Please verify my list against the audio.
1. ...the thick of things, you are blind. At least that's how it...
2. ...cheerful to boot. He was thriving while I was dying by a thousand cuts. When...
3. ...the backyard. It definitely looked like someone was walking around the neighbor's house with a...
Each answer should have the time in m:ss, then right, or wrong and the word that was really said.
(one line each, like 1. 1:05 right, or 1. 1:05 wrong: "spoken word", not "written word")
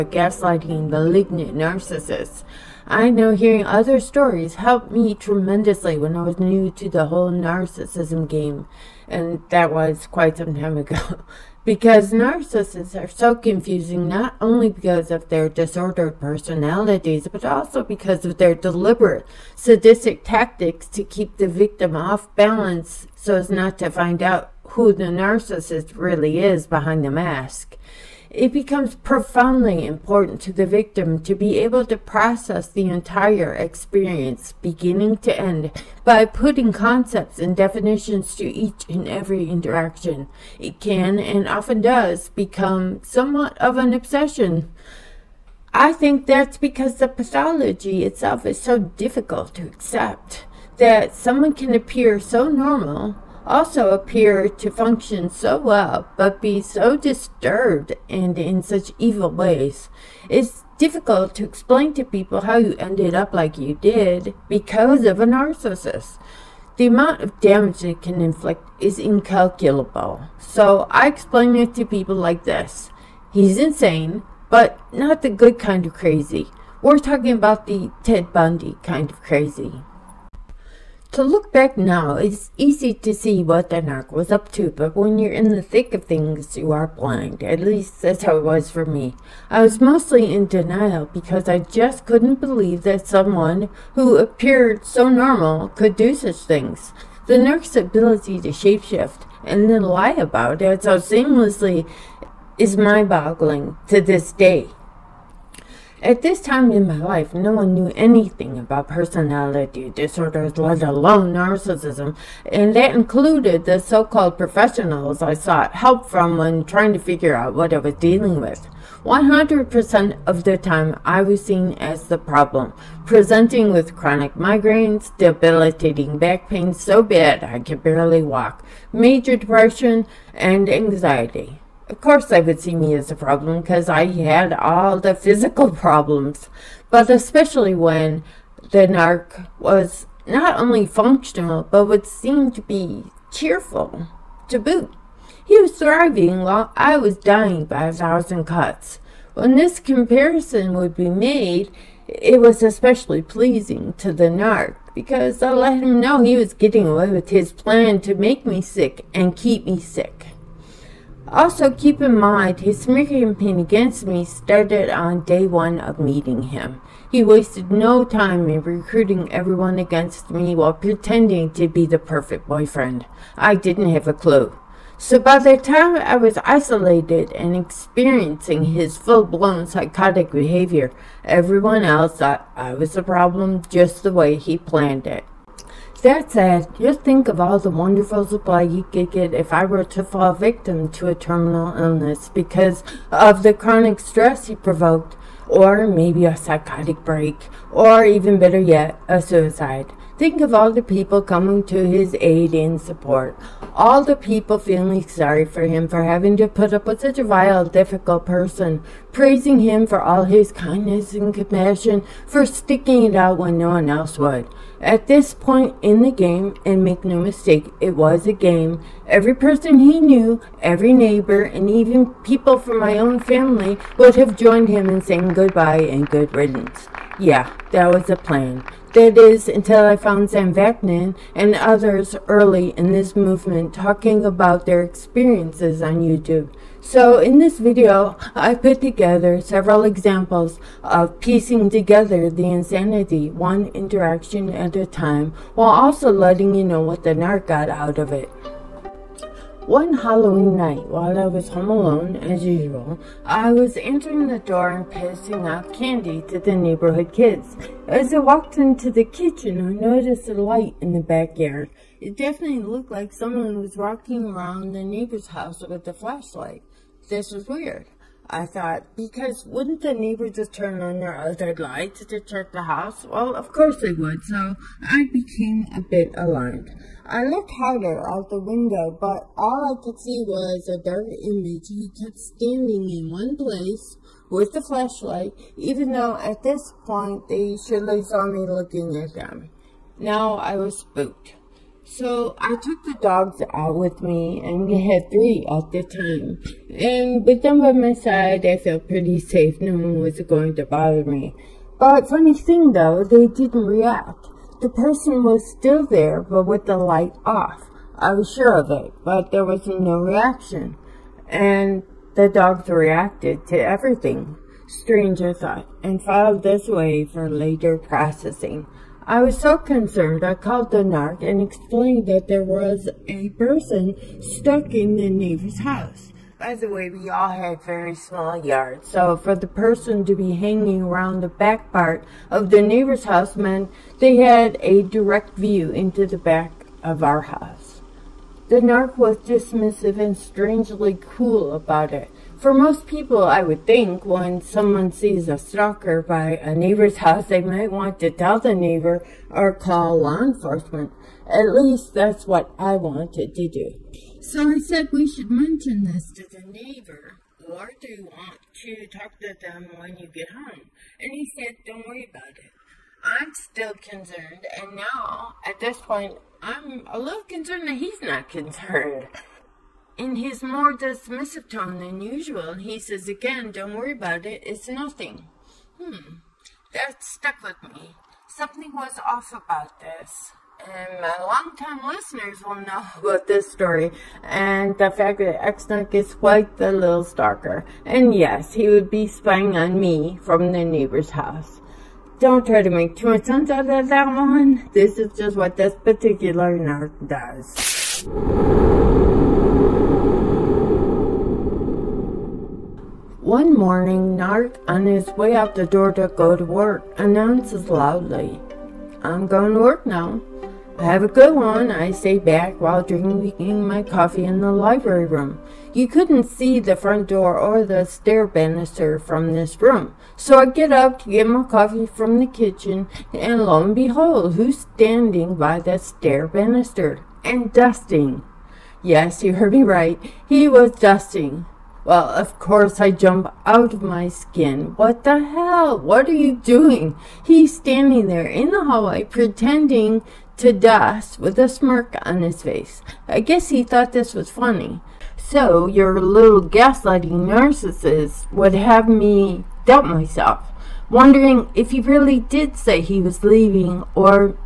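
1. 1:25 right
2. 2:23 right
3. 4:20 right.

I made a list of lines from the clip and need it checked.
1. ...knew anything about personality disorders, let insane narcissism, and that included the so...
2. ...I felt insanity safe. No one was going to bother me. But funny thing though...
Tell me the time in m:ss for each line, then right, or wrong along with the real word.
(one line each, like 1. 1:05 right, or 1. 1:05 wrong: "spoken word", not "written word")
1. 1:47 wrong: "alone", not "insane"
2. 4:58 wrong: "pretty", not "insanity".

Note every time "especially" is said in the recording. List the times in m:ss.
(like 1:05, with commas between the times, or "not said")
2:17, 2:32.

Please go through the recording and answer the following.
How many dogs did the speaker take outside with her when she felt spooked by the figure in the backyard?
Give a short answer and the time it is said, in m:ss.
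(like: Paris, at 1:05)
3, at 4:55.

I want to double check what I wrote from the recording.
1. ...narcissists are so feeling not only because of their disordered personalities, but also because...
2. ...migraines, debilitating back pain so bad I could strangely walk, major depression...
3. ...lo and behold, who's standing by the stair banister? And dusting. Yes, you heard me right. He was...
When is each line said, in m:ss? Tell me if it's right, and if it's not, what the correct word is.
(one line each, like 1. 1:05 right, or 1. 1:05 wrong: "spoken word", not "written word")
1. 0:12 wrong: "confusing", not "feeling"
2. 2:04 wrong: "barely", not "strangely"
3. 7:03 right.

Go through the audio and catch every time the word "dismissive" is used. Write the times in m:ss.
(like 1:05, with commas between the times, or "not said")
5:39, 6:10.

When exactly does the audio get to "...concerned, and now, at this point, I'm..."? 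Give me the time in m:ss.
6:03.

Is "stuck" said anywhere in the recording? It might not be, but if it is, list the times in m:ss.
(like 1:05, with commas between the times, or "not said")
5:24, 6:17.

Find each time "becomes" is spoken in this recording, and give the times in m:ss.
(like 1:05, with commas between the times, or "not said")
0:28, 0:42.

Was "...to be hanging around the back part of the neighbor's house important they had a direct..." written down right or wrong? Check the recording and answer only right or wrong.
wrong.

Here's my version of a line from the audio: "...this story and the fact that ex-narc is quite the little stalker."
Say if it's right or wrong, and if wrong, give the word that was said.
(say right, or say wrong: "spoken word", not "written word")
right.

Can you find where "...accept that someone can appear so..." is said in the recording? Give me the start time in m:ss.
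0:49.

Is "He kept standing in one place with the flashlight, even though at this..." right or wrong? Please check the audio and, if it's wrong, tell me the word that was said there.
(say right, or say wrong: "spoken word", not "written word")
right.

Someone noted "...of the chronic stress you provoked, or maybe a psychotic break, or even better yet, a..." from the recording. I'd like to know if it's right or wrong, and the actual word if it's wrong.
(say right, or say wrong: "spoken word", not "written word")
right.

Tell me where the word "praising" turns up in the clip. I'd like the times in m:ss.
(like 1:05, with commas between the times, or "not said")
3:29.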